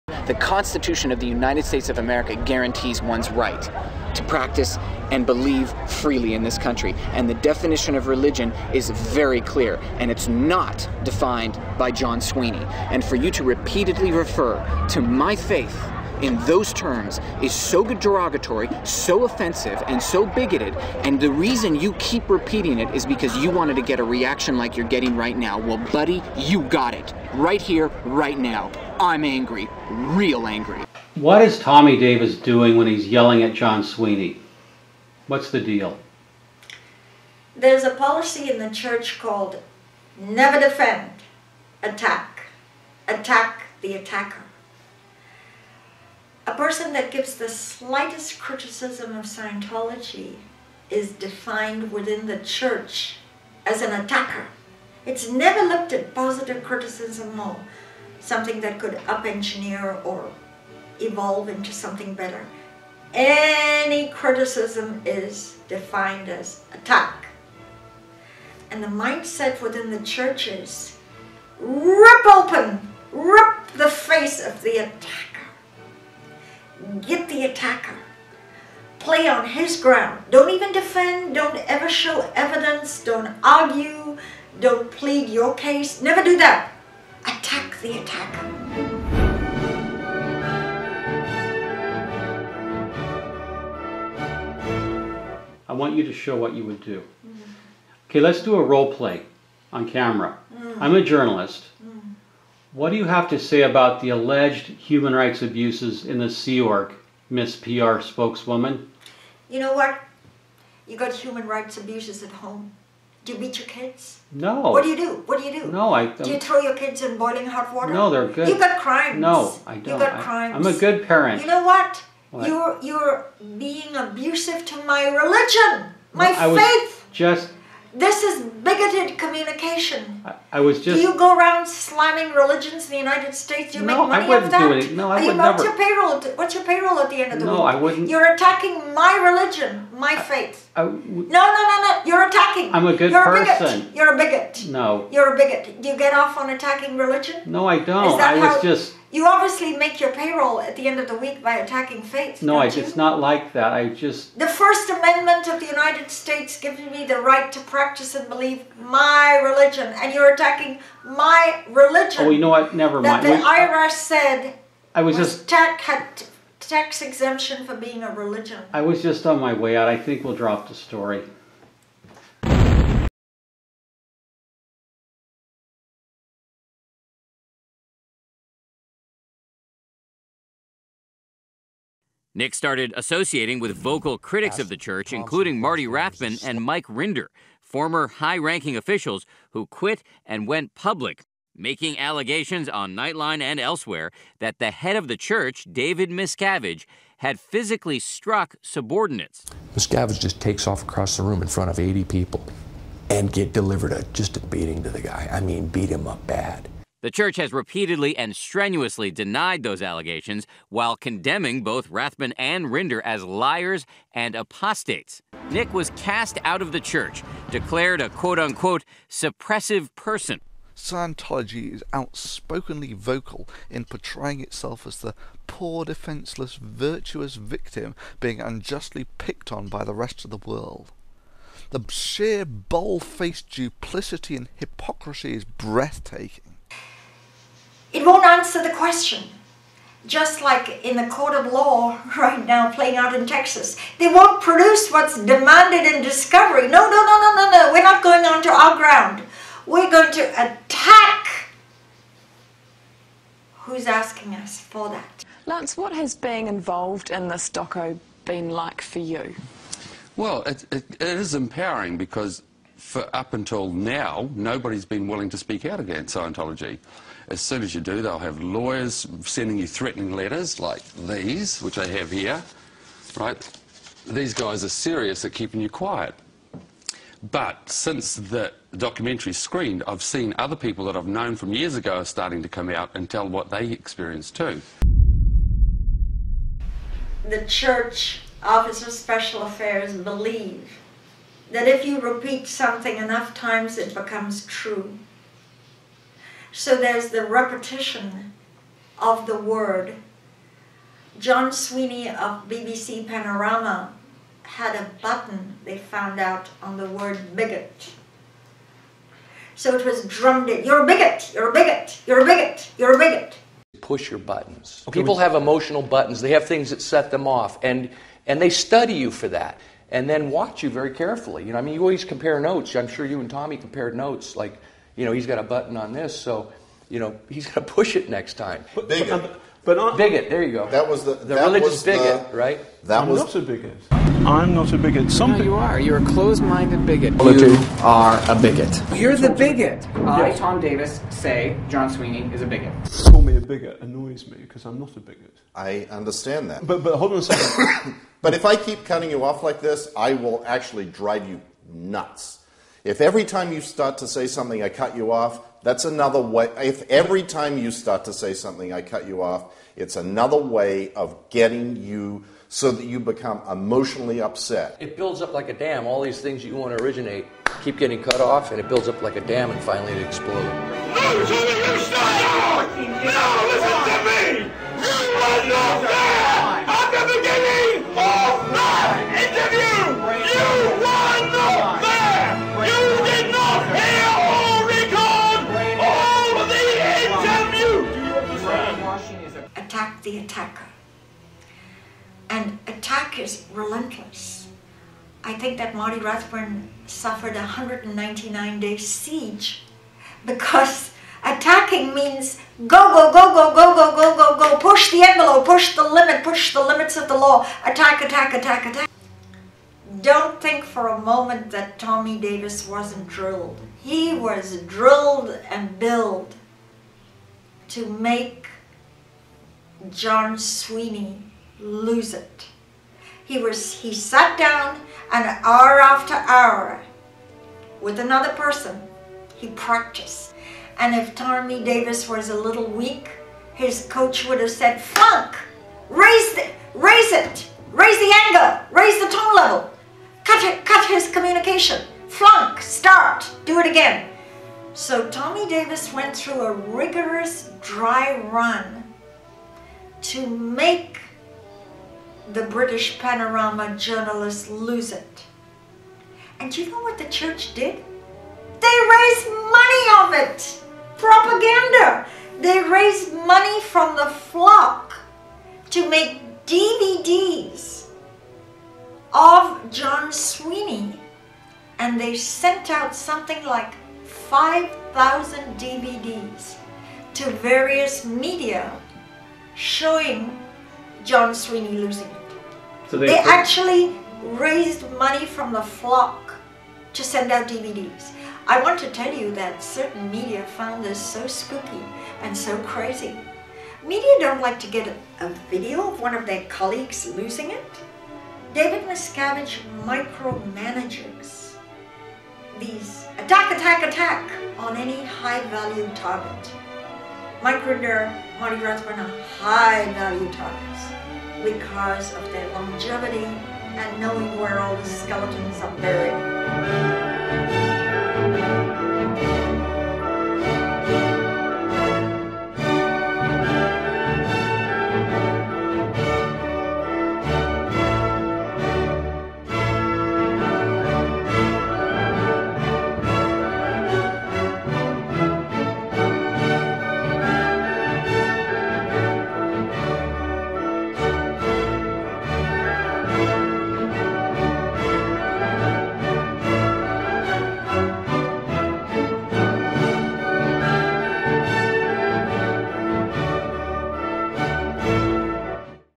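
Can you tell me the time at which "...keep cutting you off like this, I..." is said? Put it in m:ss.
5:48.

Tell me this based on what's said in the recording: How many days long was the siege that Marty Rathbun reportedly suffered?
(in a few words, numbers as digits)
199.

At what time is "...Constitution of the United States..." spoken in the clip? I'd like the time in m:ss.
0:00.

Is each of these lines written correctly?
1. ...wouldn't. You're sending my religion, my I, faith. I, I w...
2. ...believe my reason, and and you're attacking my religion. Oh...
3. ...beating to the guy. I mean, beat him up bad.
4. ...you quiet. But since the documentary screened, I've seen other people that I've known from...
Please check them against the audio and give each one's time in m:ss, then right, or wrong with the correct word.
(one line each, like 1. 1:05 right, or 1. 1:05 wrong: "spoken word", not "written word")
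1. 2:17 wrong: "attacking", not "sending"
2. 2:38 wrong: "religion", not "reason"
3. 3:24 right
4. 4:35 right.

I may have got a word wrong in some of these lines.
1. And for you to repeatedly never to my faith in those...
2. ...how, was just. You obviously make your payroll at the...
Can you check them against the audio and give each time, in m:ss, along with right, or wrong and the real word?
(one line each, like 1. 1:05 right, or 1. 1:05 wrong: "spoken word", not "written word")
1. 0:12 wrong: "refer", not "never"
2. 2:28 right.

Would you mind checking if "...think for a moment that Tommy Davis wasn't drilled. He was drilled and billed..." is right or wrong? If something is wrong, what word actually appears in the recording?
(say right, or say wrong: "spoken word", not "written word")
right.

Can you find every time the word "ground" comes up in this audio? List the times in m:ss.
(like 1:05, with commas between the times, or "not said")
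1:19, 4:08.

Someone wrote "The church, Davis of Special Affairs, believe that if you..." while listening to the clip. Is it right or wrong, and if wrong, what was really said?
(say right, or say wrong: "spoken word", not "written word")
wrong: "Office", not "Davis".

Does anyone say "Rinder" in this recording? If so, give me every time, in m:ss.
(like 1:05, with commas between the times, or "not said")
3:06, 3:32, 8:27.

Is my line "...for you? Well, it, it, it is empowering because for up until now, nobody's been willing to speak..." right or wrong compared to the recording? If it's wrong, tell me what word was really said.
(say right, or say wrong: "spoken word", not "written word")
right.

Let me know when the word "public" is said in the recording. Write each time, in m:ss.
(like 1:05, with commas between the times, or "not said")
3:10.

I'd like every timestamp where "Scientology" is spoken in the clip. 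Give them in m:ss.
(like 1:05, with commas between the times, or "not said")
0:49, 3:40, 4:26.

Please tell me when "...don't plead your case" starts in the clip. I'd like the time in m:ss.
1:24.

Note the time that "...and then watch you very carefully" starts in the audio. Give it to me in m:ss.
5:19.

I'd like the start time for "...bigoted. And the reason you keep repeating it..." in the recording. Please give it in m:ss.
0:20.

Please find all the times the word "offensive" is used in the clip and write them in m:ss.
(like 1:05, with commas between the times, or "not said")
0:19.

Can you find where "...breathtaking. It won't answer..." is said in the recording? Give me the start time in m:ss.
3:55.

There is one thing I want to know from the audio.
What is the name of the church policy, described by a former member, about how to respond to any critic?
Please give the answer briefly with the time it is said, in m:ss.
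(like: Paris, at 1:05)
Never defend, attack, at 0:40.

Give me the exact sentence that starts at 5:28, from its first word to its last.
But, bigot, but, but on, bigot.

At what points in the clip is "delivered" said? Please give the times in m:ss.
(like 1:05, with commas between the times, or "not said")
3:23.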